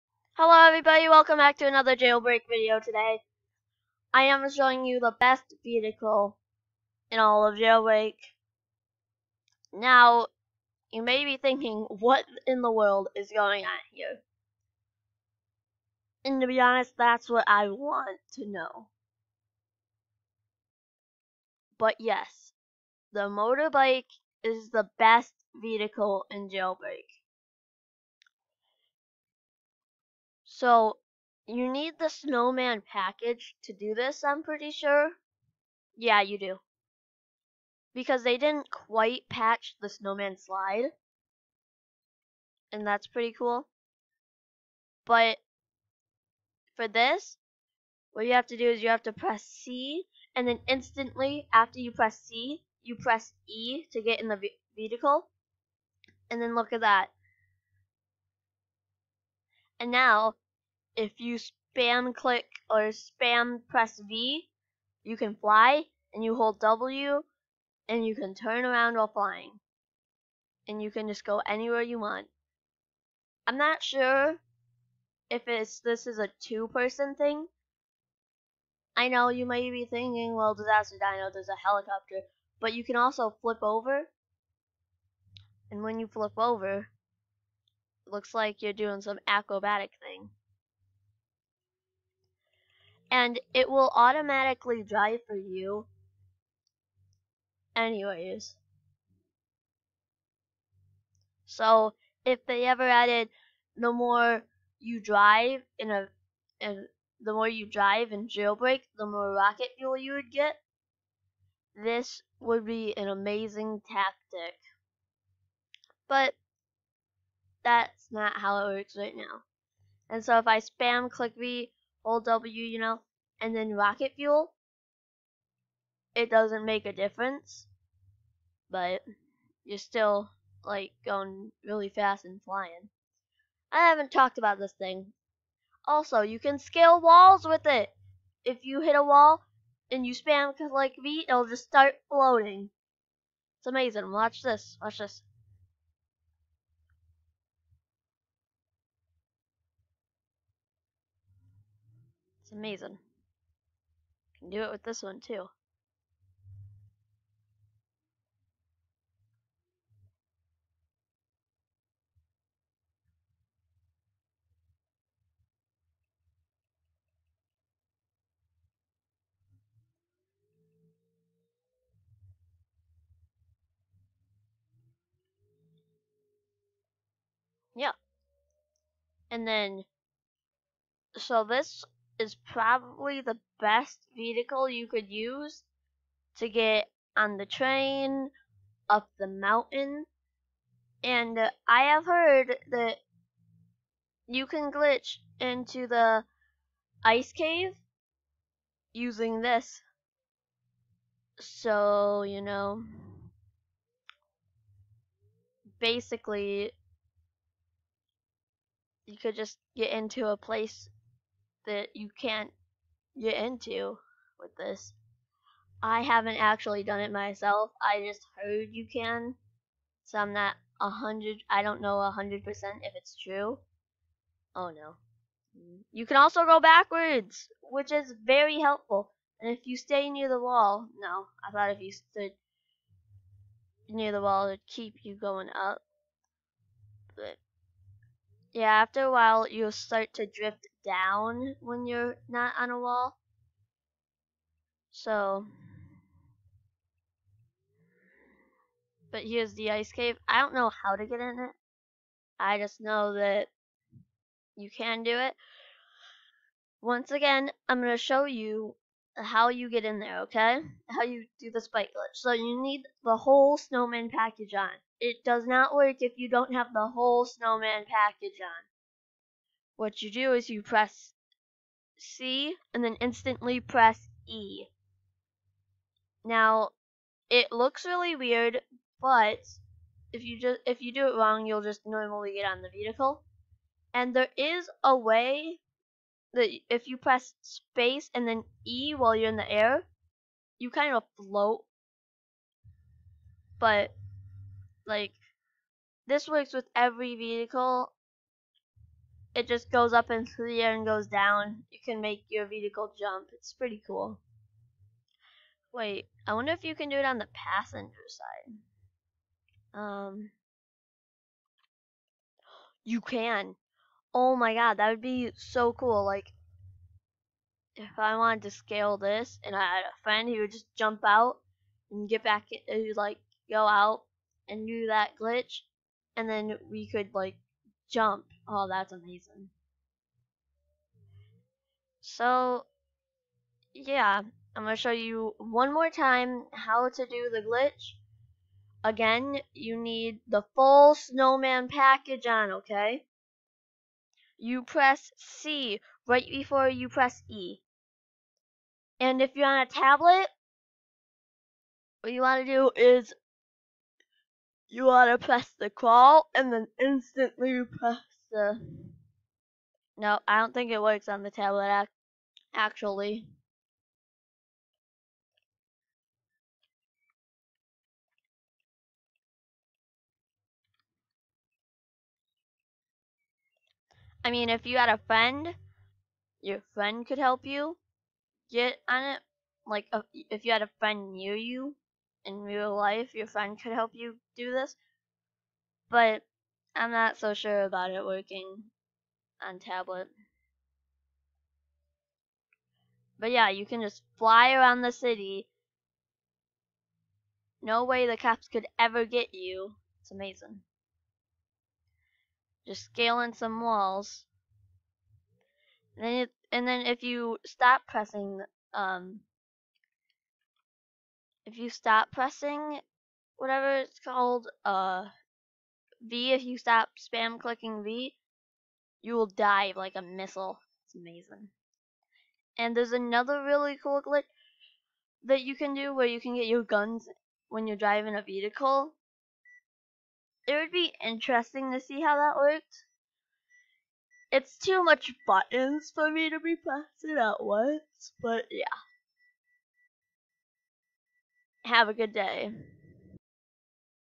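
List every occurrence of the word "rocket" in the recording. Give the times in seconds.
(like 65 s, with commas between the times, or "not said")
109 s, 123 s.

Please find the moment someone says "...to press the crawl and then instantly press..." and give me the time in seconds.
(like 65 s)
355 s.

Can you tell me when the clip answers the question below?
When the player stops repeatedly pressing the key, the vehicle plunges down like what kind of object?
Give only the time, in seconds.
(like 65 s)
420 s.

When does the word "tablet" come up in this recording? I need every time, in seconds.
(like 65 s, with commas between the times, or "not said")
349 s, 361 s, 389 s.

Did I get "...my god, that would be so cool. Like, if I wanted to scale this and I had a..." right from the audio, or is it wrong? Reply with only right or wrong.
right.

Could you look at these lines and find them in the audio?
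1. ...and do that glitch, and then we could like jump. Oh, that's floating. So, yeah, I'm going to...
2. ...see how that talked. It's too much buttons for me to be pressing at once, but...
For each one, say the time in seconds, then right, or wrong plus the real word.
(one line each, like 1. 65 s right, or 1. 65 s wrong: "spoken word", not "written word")
1. 324 s wrong: "amazing", not "floating"
2. 431 s wrong: "worked", not "talked".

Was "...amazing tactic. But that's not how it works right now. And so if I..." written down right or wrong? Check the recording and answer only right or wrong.
right.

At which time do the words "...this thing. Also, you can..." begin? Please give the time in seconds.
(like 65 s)
134 s.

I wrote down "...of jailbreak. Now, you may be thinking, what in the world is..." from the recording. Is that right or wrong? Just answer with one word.
right.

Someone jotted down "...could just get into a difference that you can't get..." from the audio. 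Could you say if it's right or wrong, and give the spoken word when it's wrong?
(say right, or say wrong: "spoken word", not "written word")
wrong: "place", not "difference".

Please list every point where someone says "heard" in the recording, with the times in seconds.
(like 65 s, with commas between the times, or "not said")
192 s, 218 s.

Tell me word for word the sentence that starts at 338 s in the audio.
Again, you need the full snowman package on, okay?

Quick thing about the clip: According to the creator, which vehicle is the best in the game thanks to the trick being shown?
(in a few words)
motorbike.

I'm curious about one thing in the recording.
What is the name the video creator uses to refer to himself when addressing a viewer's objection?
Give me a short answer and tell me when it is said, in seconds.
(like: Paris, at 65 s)
Disaster Dino, at 80 s.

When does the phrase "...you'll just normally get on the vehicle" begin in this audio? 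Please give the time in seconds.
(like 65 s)
281 s.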